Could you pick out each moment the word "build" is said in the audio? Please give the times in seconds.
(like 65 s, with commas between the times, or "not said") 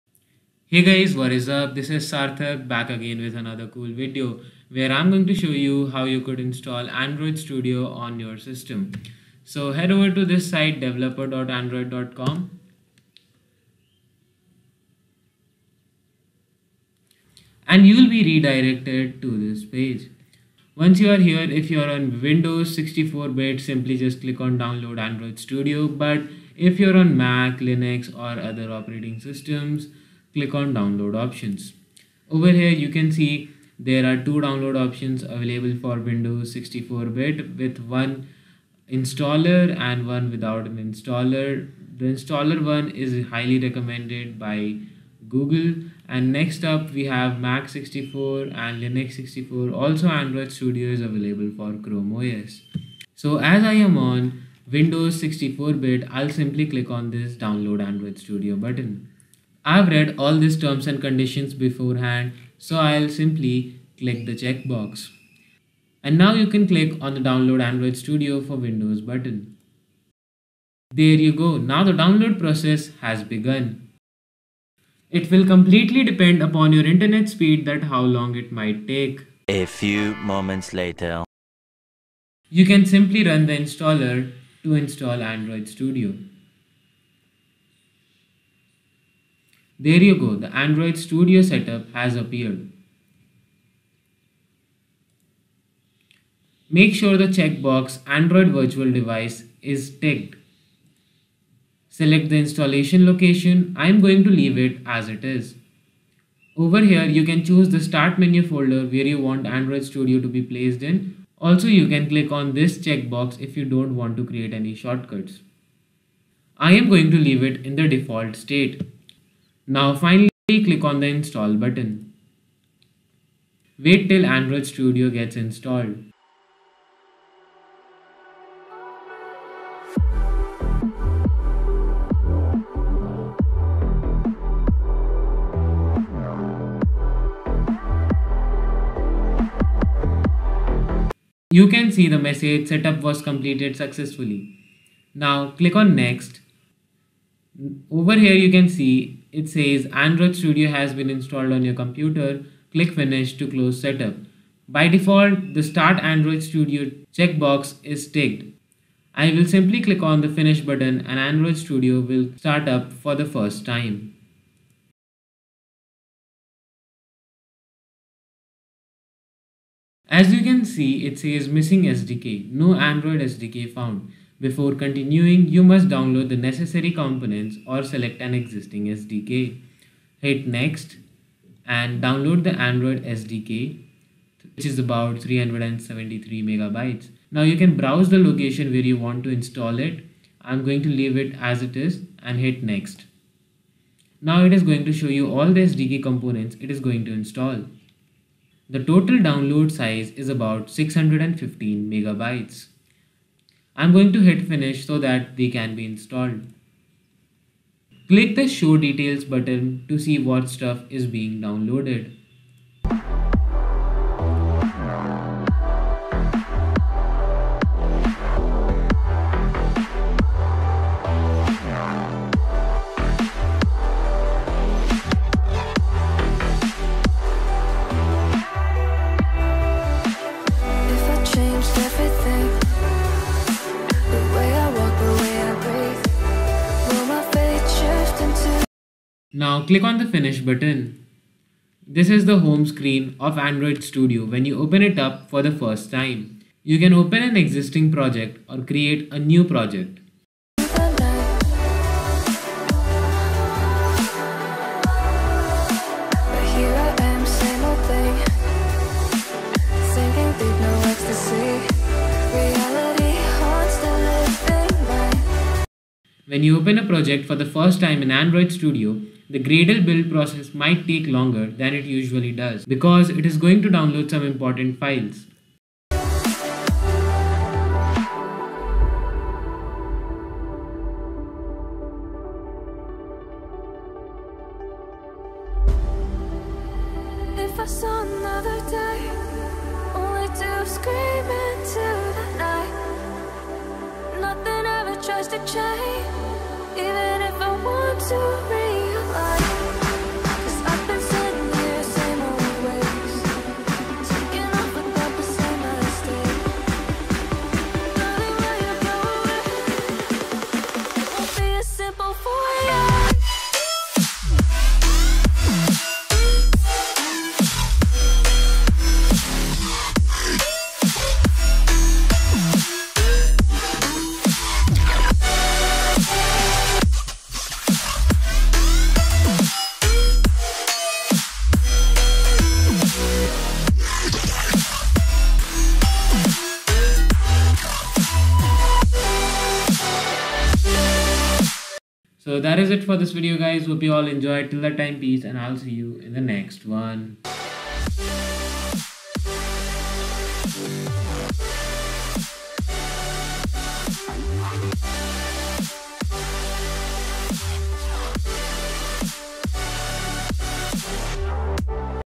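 269 s.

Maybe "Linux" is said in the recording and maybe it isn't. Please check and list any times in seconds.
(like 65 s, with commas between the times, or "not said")
27 s, 48 s.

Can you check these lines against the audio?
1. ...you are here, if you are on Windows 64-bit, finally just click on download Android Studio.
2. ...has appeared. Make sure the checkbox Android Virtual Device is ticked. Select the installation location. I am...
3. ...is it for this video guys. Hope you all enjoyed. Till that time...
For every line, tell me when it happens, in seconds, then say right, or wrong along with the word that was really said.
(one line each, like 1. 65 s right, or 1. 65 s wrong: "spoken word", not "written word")
1. 21 s wrong: "simply", not "finally"
2. 91 s right
3. 342 s right.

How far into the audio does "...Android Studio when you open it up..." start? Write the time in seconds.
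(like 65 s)
243 s.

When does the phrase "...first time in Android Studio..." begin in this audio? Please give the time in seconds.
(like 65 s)
267 s.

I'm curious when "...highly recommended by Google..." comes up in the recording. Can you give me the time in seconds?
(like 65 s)
43 s.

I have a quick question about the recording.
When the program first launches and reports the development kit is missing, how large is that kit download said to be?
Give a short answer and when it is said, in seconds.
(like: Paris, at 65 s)
373 megabytes, at 185 s.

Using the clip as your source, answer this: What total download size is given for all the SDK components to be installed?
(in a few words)
615 megabytes.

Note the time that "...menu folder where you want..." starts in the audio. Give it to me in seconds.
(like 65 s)
108 s.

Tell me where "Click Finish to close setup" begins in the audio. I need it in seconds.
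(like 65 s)
152 s.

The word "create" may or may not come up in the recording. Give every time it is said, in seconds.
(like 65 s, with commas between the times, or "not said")
114 s, 248 s.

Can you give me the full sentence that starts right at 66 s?
And now you can click on the download Android Studio for Windows button.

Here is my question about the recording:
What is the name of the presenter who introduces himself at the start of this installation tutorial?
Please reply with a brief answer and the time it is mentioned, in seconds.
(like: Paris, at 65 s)
Sarthak, at 2 s.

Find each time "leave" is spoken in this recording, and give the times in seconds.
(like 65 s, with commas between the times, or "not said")
104 s, 117 s, 190 s.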